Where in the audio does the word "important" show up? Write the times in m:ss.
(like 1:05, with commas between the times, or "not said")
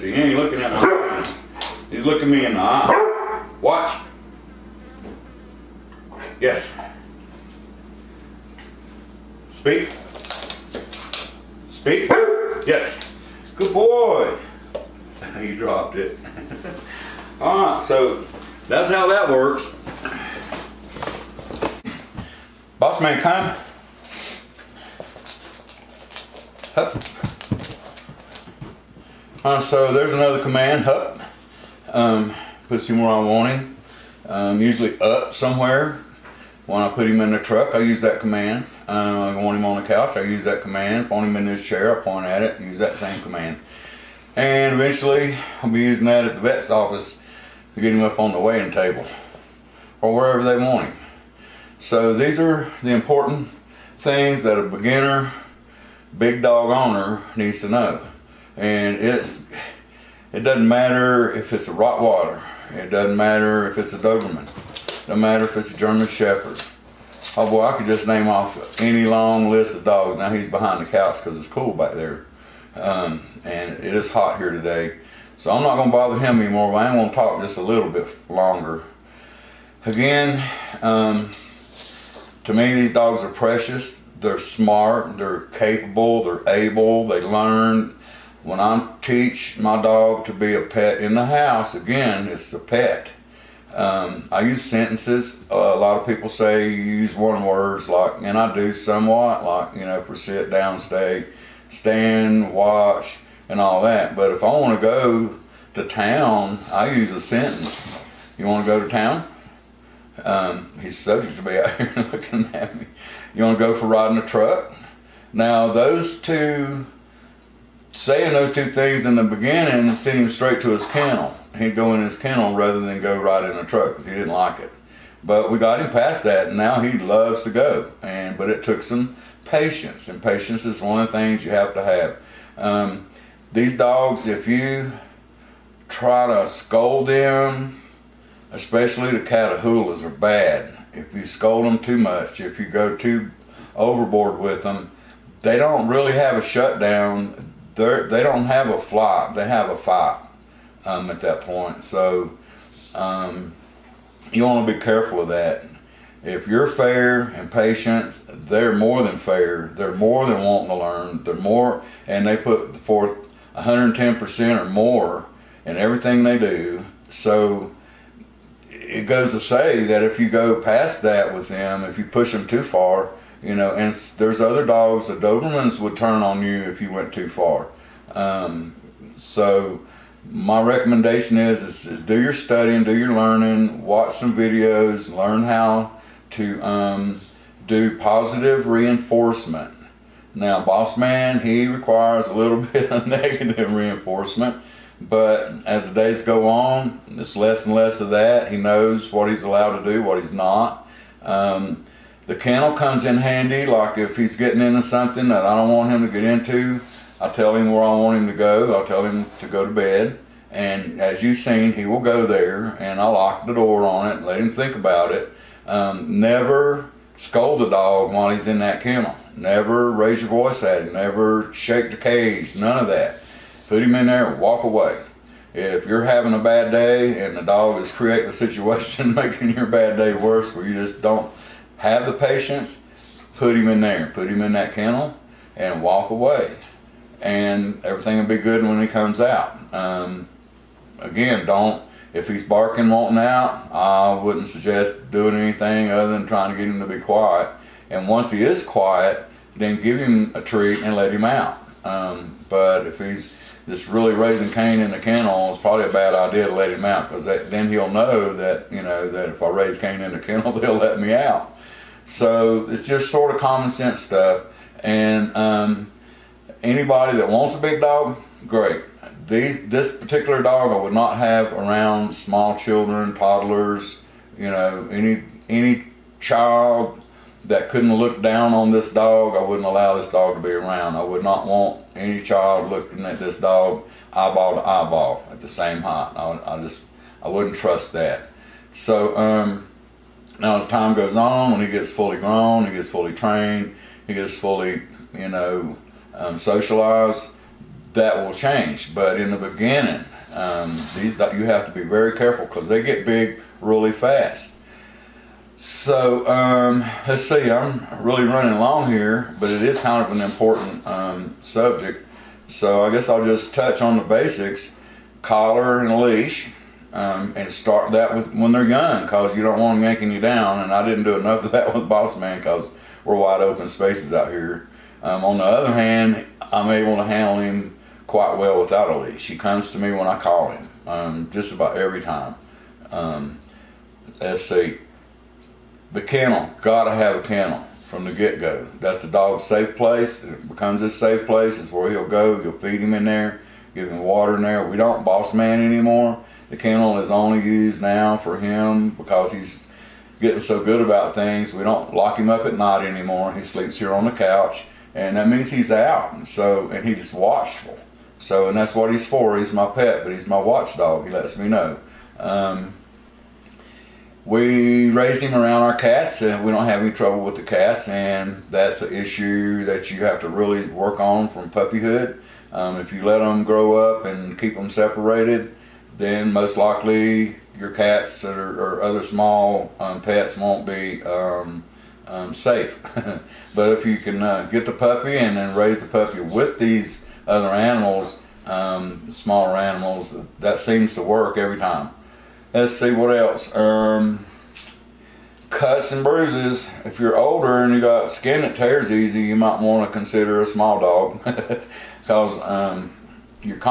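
0:52, 5:10.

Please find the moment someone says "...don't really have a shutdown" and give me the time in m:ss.
2:25.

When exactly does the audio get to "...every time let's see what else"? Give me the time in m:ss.
6:31.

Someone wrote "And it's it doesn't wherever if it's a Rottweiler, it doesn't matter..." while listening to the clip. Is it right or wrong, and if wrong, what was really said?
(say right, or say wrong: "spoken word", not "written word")
wrong: "matter", not "wherever".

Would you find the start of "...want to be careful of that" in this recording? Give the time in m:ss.
2:34.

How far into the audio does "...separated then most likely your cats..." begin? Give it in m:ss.
6:14.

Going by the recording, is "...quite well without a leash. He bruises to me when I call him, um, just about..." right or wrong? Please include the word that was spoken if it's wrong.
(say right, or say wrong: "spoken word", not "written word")
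wrong: "comes", not "bruises".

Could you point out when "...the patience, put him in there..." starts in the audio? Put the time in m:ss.
3:52.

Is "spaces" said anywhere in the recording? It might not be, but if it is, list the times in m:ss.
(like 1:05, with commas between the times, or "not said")
5:23.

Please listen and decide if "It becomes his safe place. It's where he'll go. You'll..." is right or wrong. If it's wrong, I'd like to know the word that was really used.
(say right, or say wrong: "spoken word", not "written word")
right.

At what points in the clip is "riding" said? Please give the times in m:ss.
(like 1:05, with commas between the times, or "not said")
1:53.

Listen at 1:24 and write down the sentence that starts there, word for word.
They're smart, they're capable, they're able, they learn.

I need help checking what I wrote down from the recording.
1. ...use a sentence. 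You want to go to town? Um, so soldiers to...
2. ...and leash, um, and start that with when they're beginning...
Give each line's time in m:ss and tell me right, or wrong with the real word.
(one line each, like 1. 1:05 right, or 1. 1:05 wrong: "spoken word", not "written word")
1. 1:46 right
2. 5:15 wrong: "young", not "beginning".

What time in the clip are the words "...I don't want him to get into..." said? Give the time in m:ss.
3:25.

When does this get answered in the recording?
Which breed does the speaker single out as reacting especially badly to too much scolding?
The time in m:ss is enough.
2:19.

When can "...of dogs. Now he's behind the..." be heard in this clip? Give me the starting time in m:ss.
1:09.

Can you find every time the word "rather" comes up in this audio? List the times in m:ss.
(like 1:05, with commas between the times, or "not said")
2:02.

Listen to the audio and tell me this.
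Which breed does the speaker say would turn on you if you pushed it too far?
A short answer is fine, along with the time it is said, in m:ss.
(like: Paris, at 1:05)
Dobermans, at 2:55.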